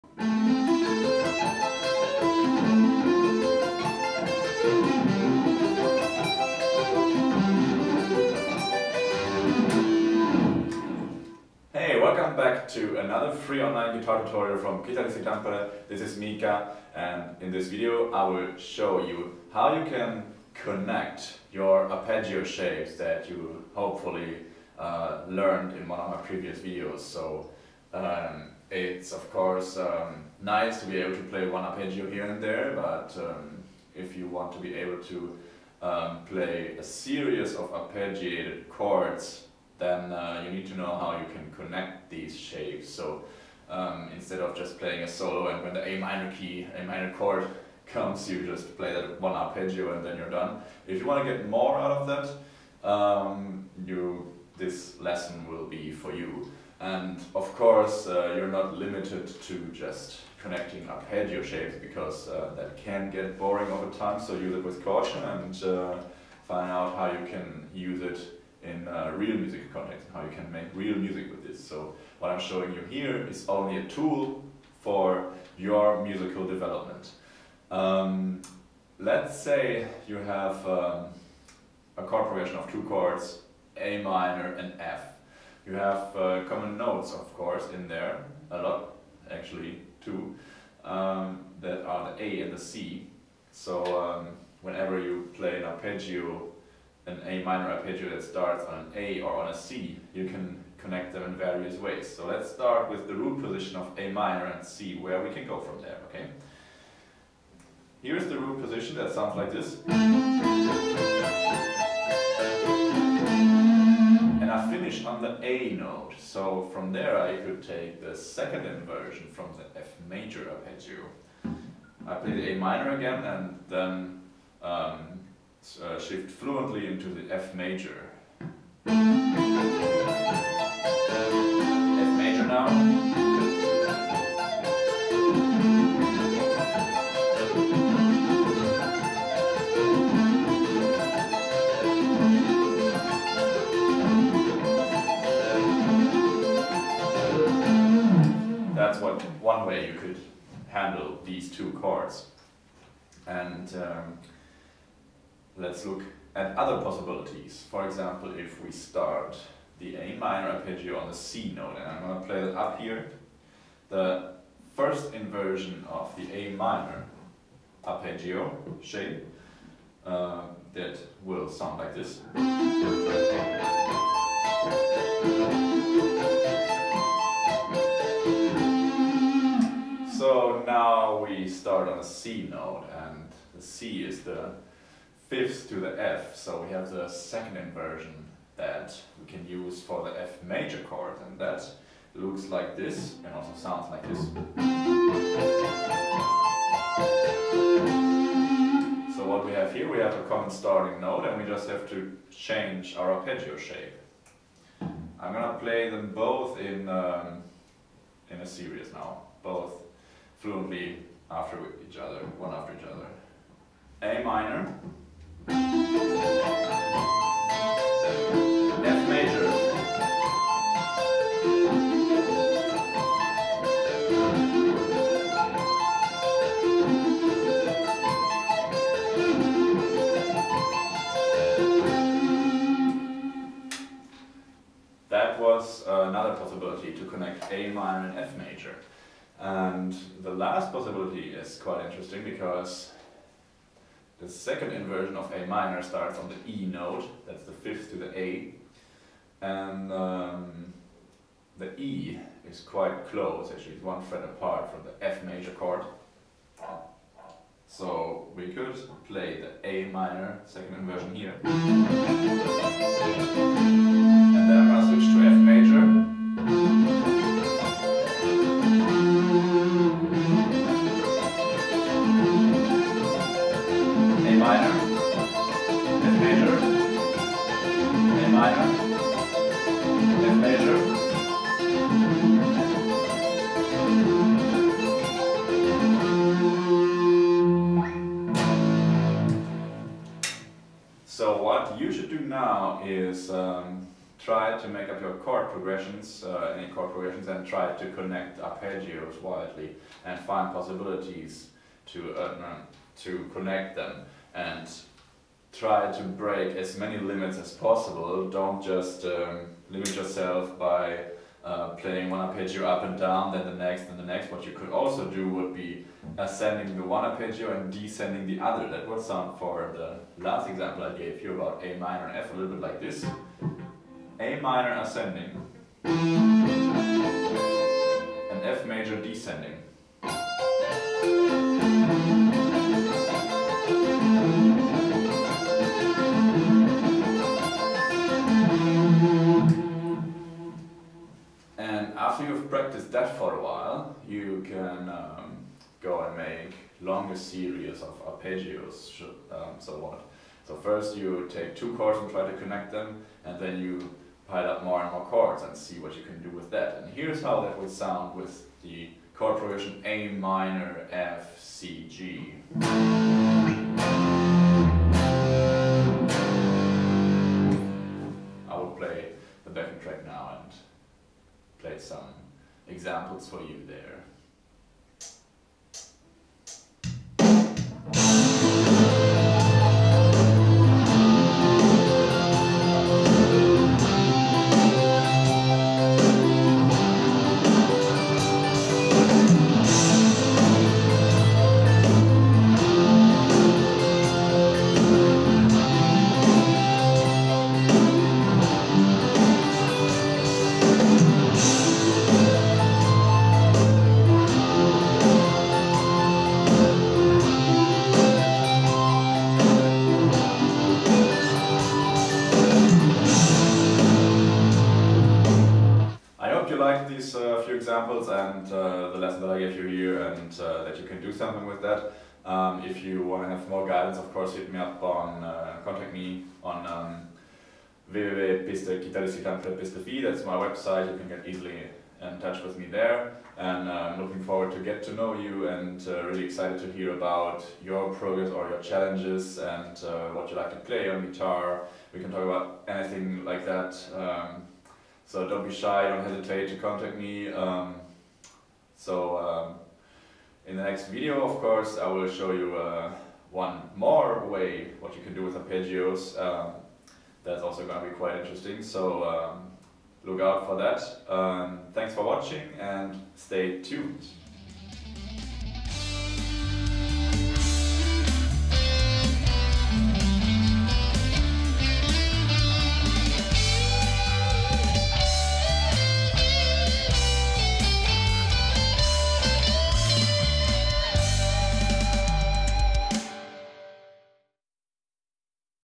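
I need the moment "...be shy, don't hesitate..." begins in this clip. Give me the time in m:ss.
7:25.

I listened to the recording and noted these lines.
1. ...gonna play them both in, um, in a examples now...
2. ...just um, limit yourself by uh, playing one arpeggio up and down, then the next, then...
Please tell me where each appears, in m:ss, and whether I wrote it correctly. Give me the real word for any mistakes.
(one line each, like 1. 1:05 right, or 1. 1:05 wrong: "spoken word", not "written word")
1. 3:25 wrong: "series", not "examples"
2. 5:08 right.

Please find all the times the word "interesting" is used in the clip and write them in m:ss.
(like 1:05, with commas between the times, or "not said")
4:01, 7:38.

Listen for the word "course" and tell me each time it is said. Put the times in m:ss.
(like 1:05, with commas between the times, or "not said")
0:29, 0:57, 1:27, 7:04, 7:31.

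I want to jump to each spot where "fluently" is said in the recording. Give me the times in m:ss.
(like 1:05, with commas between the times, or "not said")
2:06, 3:30.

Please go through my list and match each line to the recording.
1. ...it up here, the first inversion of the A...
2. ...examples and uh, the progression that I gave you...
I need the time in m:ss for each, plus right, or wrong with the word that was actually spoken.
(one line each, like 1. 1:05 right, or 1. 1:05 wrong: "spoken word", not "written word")
1. 2:42 right
2. 6:57 wrong: "lesson", not "progression".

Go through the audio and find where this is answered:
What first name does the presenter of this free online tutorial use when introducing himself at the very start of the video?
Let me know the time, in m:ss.
0:16.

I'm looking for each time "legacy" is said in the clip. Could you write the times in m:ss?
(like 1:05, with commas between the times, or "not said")
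not said.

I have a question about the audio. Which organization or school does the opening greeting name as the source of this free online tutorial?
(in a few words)
Kitaristi Tampere.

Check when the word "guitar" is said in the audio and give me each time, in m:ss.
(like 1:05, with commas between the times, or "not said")
0:13, 7:21.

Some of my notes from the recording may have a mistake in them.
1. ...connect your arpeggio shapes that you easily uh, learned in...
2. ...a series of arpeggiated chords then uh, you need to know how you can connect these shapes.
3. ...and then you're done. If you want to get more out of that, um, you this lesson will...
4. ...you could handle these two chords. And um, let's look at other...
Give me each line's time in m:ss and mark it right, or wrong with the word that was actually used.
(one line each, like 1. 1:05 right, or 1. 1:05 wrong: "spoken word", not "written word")
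1. 0:20 wrong: "hopefully", not "easily"
2. 0:36 right
3. 0:49 right
4. 2:29 right.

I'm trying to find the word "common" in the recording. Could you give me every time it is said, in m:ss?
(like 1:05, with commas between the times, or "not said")
1:26, 3:20.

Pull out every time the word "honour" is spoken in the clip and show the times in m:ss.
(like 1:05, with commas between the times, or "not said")
not said.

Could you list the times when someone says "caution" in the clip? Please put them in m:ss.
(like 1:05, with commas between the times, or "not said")
1:04.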